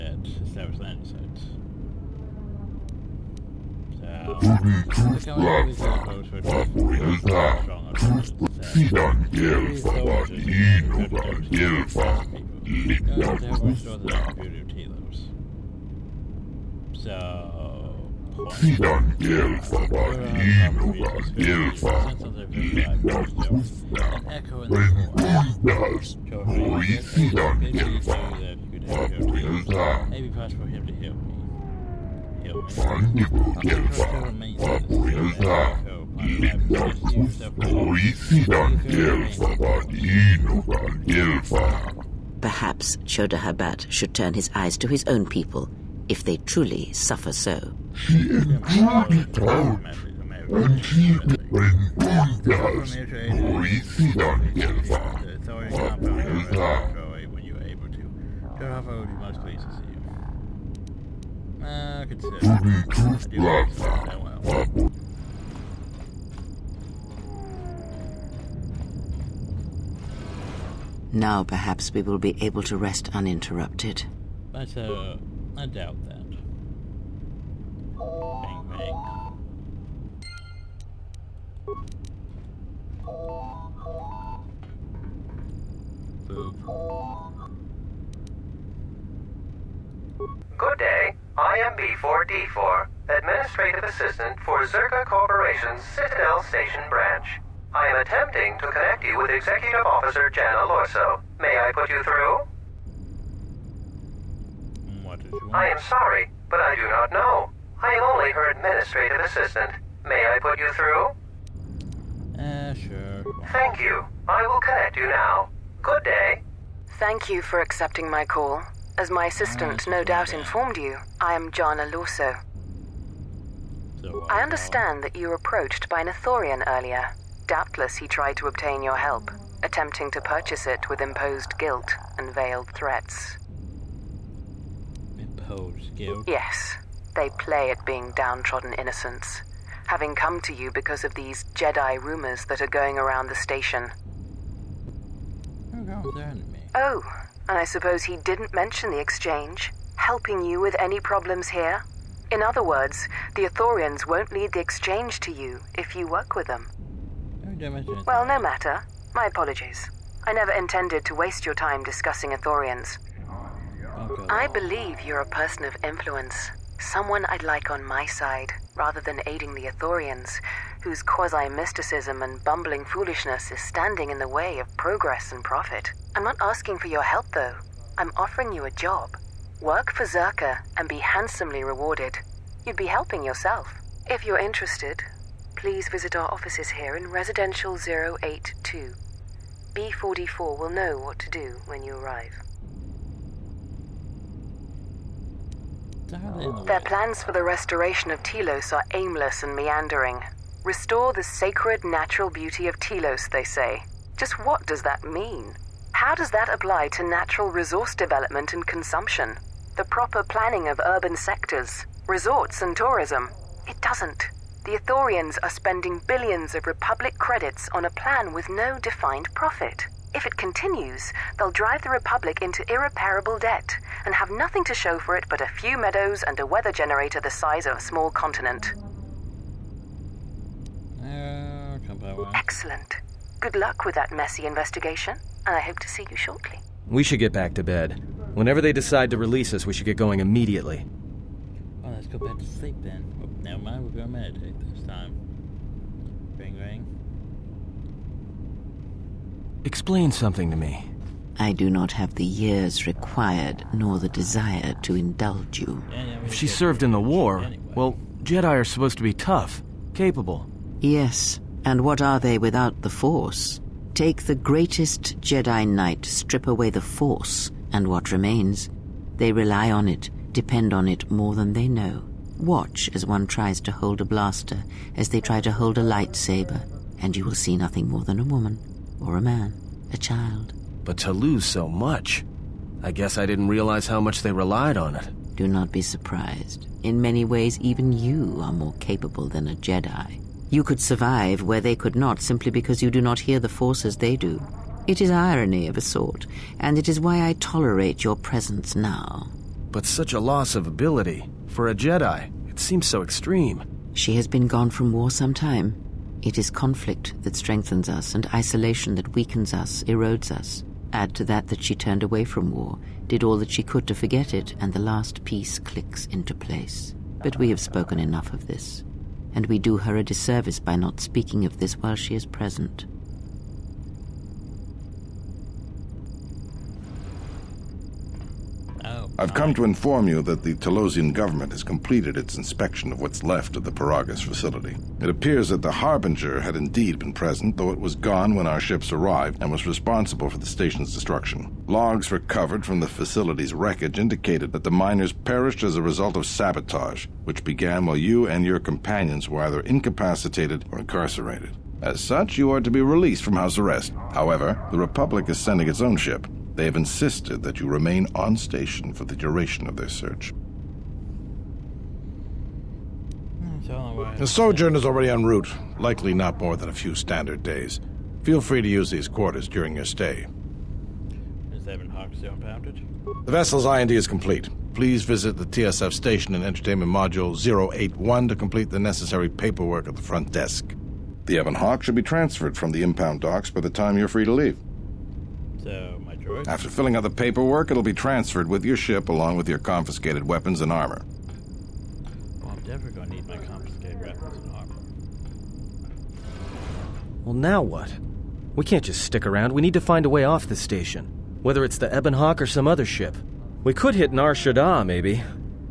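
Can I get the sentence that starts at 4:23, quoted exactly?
Take the greatest Jedi Knight, strip away the Force, and what remains?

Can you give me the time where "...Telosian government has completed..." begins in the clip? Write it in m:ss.
5:30.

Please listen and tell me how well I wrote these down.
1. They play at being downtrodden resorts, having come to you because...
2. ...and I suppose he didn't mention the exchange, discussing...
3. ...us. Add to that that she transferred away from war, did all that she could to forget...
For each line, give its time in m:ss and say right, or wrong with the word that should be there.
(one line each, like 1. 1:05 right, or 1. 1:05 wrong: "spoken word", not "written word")
1. 2:17 wrong: "innocents", not "resorts"
2. 2:27 wrong: "helping", not "discussing"
3. 5:10 wrong: "turned", not "transferred".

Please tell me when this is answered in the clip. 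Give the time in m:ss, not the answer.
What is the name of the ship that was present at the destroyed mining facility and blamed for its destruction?
5:35.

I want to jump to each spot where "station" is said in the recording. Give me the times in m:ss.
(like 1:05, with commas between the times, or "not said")
1:36, 2:23, 5:40, 5:58, 6:15, 6:40.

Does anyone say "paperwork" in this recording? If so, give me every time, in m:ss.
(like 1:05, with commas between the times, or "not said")
6:19, 6:27.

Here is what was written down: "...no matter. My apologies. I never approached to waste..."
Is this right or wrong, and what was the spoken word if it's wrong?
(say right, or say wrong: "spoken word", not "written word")
wrong: "intended", not "approached".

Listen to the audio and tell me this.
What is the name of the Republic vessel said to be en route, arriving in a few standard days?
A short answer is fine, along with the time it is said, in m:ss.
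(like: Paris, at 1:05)
Sojourn, at 6:04.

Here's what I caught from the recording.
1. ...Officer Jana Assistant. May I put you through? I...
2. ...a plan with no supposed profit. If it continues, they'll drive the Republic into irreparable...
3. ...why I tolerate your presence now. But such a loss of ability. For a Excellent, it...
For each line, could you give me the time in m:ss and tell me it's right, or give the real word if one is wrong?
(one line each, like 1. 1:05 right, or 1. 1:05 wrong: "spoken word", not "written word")
1. 1:39 wrong: "Lorso", not "Assistant"
2. 3:37 wrong: "defined", not "supposed"
3. 4:57 wrong: "Jedi", not "Excellent".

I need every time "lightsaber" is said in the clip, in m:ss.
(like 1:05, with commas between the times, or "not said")
4:35.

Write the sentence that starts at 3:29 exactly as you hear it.
The proper planning of urban sectors, resorts and tourism?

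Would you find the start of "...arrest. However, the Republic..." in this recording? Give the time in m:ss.
5:53.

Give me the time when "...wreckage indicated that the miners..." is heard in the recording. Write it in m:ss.
5:43.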